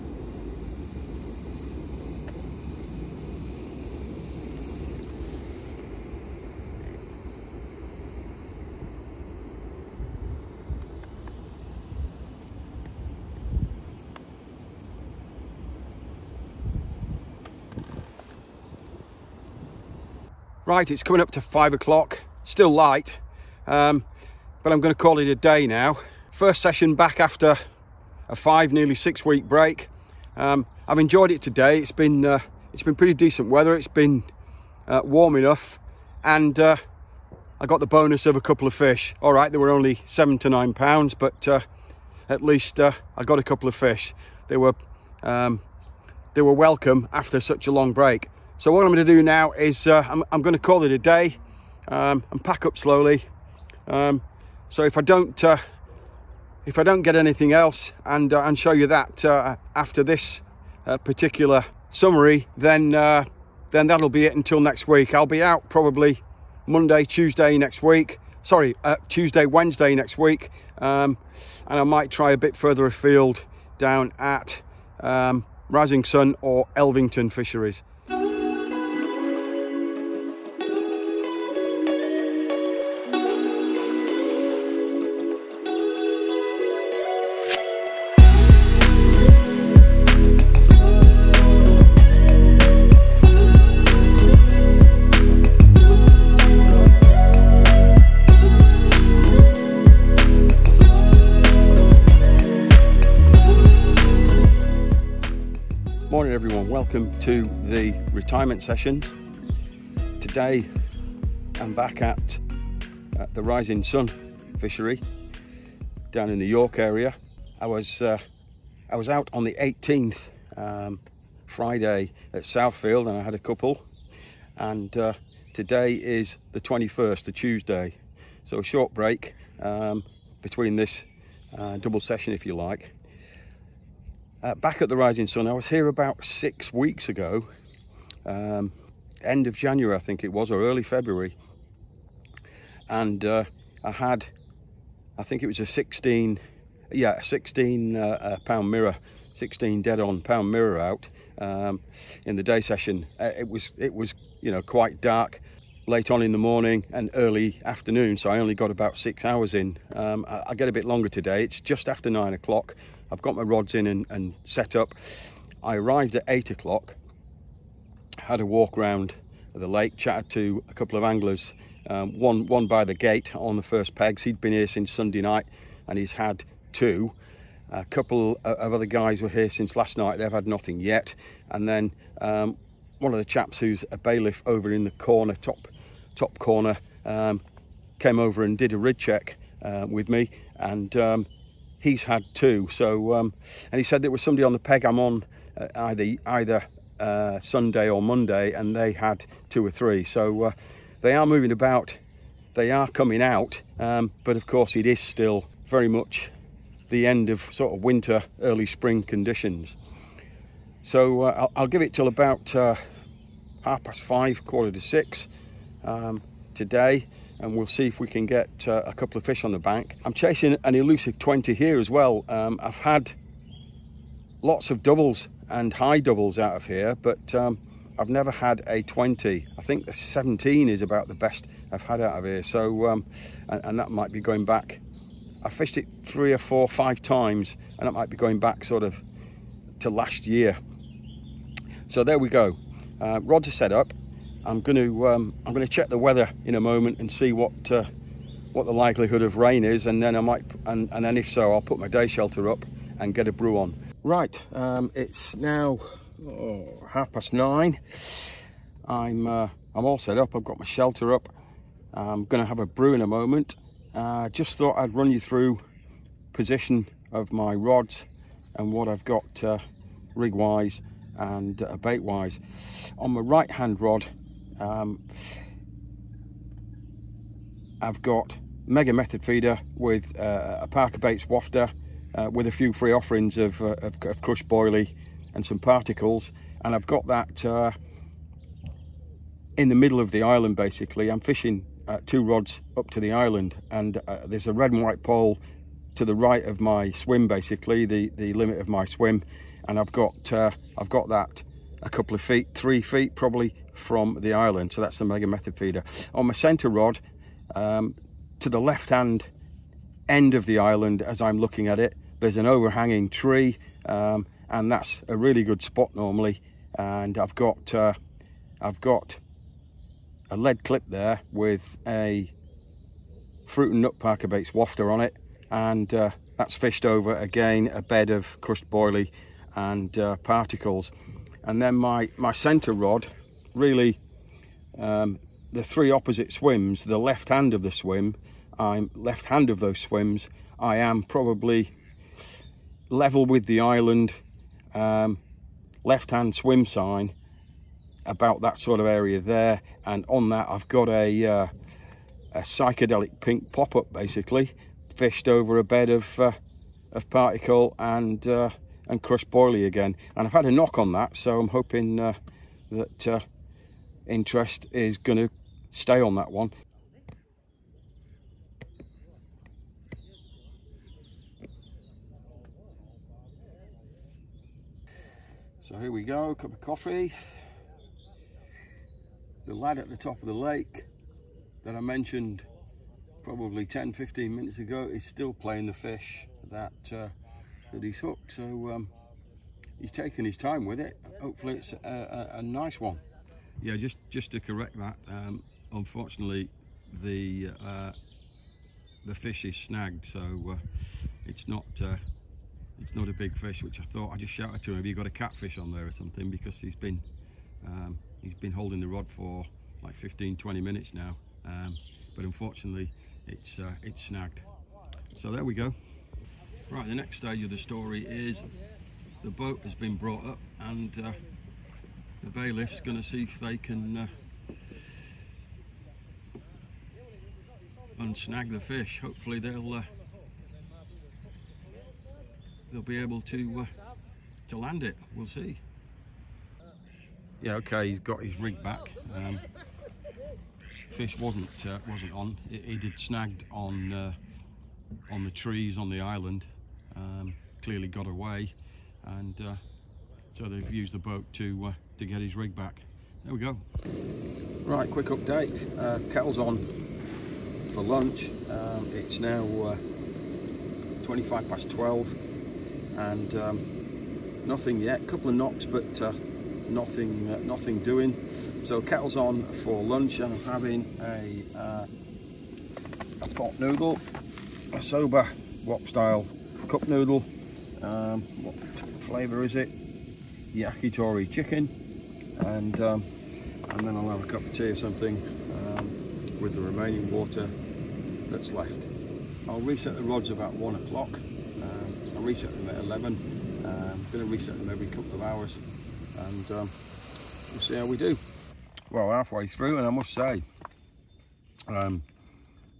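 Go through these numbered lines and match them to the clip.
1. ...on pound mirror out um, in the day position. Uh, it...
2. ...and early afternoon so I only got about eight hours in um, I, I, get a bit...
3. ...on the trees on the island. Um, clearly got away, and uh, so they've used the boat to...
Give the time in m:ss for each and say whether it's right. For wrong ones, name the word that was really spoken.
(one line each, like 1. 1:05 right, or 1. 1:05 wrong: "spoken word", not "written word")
1. 2:30 wrong: "session", not "position"
2. 2:36 wrong: "six", not "eight"
3. 7:25 right.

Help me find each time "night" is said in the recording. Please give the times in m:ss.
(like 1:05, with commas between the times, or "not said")
2:55, 2:59.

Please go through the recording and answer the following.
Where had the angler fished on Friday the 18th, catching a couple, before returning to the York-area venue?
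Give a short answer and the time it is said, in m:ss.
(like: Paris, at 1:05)
Southfield, at 2:02.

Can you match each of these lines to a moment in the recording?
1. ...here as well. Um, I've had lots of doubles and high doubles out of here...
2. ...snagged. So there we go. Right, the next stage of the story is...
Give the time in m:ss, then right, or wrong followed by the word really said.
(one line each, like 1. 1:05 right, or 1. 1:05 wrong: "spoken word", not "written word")
1. 3:41 right
2. 6:54 right.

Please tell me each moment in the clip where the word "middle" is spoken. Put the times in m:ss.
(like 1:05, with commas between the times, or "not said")
4:49.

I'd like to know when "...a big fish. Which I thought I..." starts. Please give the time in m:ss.
6:43.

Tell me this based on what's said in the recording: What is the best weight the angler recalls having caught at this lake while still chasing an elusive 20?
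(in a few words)
17.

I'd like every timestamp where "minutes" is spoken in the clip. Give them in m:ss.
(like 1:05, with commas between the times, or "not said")
6:24, 6:50.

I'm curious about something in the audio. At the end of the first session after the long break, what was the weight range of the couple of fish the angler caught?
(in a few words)
7 to 9 pounds.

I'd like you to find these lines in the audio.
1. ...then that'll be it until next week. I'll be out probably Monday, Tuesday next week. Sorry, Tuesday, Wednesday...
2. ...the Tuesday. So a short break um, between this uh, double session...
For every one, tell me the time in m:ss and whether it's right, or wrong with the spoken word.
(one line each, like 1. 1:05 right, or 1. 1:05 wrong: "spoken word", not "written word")
1. 1:03 right
2. 2:07 right.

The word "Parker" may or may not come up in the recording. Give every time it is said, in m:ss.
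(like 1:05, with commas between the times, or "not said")
4:40, 5:23.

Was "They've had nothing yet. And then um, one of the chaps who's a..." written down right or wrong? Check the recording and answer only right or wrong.
right.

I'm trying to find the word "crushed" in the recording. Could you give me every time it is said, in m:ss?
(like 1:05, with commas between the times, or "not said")
4:44, 5:28, 5:59.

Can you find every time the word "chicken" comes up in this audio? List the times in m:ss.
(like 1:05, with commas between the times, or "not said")
8:01.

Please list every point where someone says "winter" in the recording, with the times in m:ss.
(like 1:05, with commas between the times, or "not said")
3:27.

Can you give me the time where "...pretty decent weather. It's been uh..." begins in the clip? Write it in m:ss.
0:32.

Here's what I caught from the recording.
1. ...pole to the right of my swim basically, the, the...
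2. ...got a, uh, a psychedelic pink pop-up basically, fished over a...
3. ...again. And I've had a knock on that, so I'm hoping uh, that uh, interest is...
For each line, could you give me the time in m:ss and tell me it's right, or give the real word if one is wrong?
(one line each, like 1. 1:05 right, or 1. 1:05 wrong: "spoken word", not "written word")
1. 4:55 right
2. 5:50 right
3. 5:59 right.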